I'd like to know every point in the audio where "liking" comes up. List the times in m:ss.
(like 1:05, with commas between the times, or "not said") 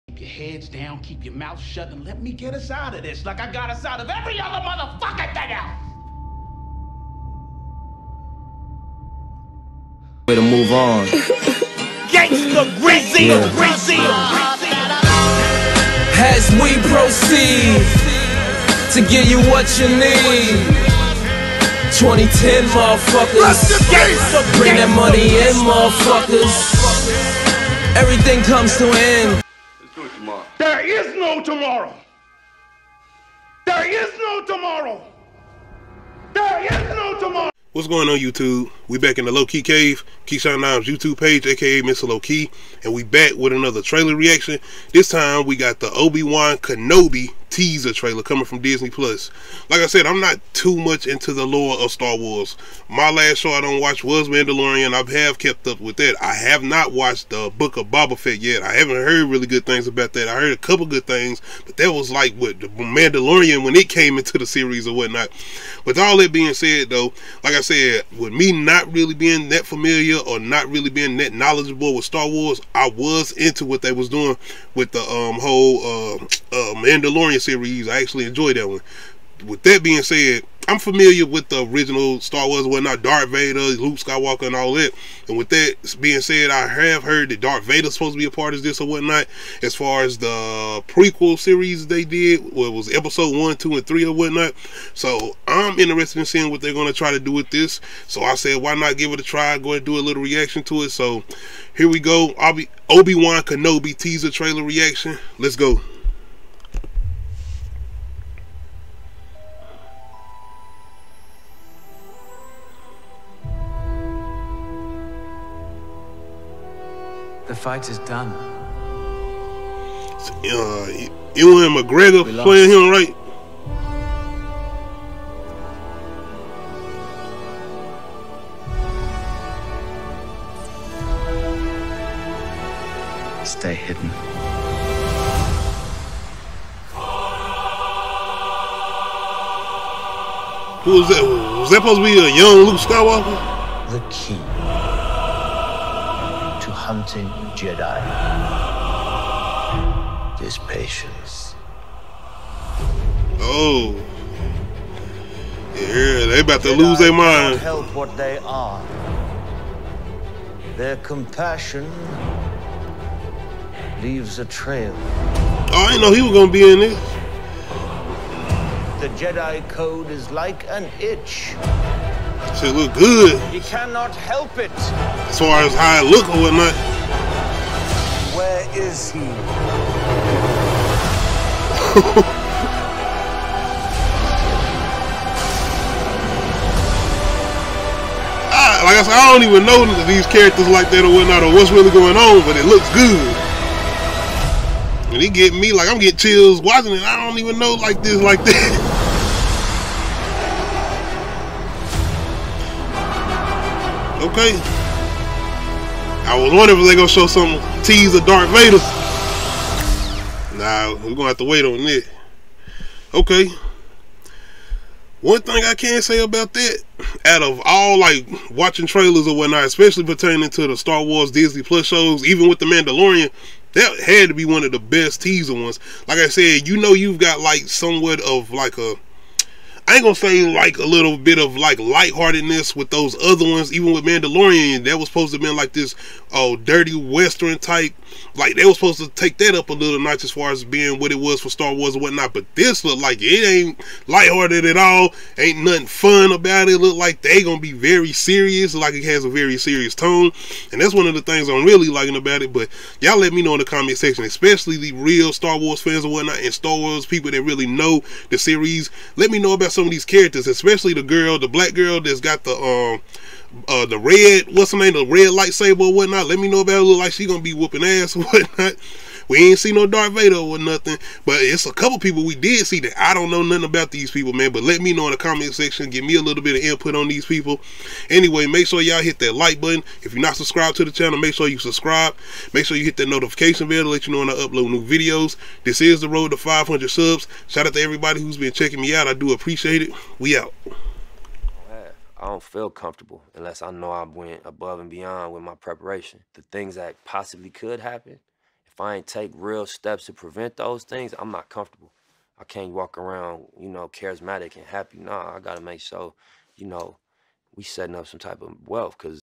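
4:11.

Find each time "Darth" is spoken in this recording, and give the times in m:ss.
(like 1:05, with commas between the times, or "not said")
1:23, 1:27, 3:28, 4:29.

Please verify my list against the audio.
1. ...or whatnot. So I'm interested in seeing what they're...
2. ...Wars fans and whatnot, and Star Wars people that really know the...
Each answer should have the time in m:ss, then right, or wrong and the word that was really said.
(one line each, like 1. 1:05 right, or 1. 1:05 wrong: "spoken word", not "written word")
1. 1:34 right
2. 4:15 right.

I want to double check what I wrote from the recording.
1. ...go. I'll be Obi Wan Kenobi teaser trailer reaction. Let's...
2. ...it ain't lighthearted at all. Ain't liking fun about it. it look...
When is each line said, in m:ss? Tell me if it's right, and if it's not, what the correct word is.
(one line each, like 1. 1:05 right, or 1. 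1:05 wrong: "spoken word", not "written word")
1. 1:41 right
2. 4:03 wrong: "nothing", not "liking".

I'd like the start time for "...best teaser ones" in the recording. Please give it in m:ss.
3:44.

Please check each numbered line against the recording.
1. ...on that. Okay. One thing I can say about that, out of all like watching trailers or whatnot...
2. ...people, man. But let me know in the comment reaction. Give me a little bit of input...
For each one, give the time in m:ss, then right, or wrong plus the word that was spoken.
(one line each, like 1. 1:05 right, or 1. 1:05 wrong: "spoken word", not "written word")
1. 3:31 right
2. 4:34 wrong: "section", not "reaction".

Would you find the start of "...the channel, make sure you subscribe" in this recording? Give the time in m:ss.
4:40.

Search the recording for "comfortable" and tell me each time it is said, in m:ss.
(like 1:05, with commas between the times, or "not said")
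4:52, 5:01.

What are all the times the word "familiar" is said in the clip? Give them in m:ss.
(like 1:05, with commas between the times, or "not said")
1:09, 1:20.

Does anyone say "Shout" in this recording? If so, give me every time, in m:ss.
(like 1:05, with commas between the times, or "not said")
4:47.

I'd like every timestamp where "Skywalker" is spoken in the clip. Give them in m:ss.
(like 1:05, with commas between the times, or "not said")
1:23, 2:22.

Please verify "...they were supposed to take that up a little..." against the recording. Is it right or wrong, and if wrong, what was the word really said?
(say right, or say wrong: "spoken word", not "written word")
right.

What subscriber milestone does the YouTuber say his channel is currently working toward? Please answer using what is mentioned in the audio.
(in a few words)
500 subs.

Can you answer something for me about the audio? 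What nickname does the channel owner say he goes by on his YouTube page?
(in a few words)
Mr. Low Key.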